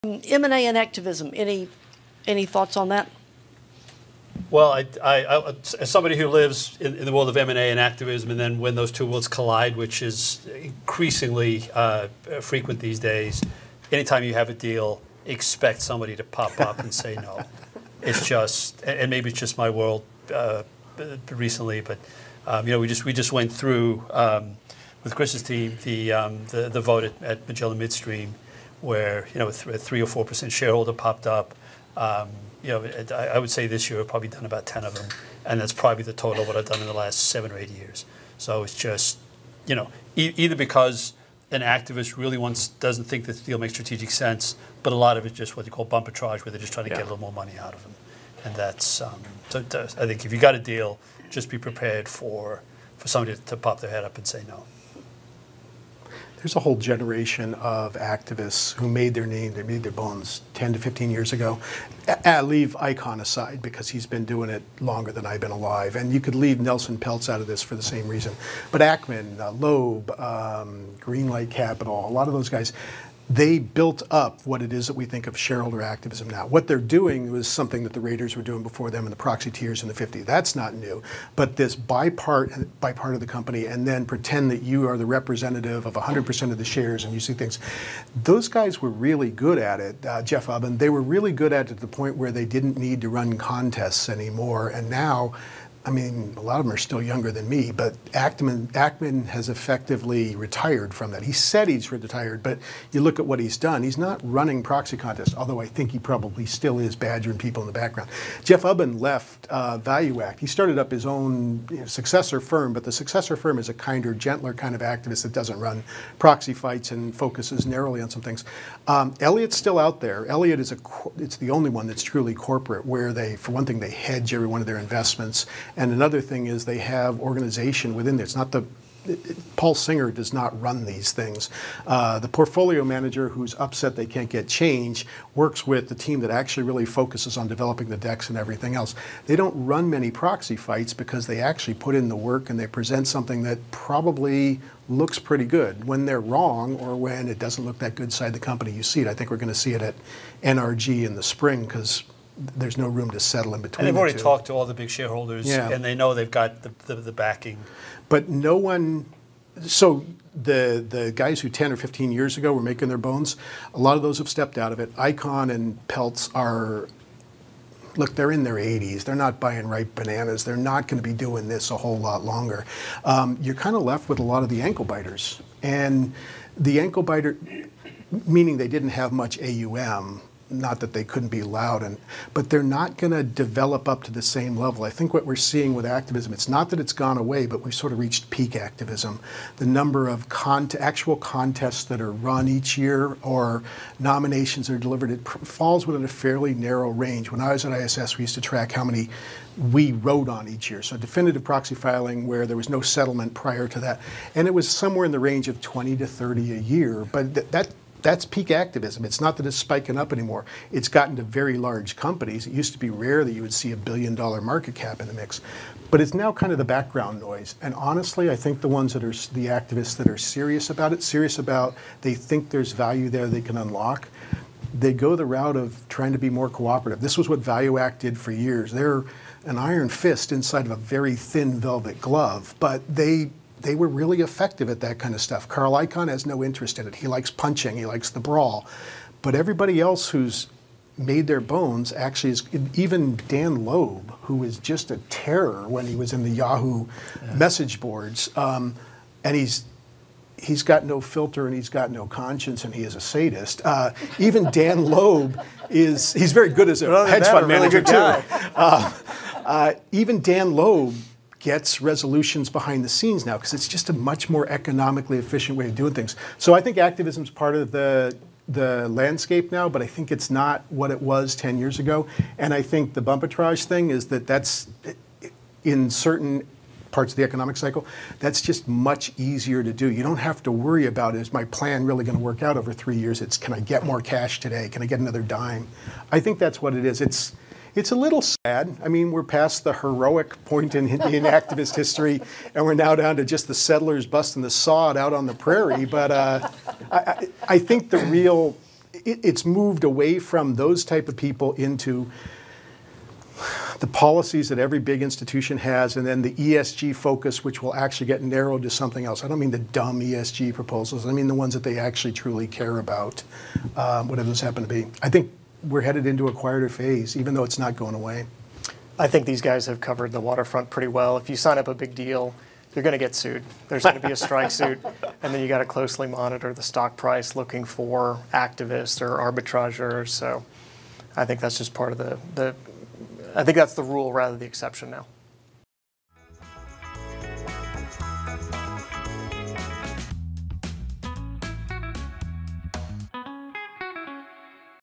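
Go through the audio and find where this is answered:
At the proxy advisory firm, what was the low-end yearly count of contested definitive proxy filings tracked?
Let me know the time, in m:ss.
3:25.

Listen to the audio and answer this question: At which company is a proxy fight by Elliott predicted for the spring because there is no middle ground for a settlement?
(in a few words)
NRG.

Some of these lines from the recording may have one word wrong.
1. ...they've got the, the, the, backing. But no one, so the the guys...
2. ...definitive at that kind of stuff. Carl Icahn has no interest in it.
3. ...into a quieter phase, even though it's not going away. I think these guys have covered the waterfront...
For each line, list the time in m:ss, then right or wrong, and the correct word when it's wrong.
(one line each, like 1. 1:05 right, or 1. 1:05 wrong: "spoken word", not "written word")
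1. 2:36 right
2. 3:54 wrong: "effective", not "definitive"
3. 5:16 right.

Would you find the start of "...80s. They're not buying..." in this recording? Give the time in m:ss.
2:48.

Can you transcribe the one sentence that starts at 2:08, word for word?
It's not the Paul Singer does not run these things.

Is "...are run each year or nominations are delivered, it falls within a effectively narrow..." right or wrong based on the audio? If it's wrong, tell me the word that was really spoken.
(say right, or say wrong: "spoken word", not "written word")
wrong: "fairly", not "effectively".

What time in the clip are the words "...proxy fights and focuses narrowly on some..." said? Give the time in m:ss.
1:56.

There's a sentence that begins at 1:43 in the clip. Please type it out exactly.
He's not running proxy contests, although I think he probably still is badgering people in the background.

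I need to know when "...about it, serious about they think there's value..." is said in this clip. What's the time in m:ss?
3:40.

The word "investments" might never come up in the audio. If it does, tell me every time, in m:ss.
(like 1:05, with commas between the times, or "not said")
2:04.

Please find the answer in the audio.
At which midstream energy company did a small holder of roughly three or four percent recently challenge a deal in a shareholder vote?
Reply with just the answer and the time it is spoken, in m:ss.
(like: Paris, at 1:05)
Magellan Midstream, at 0:27.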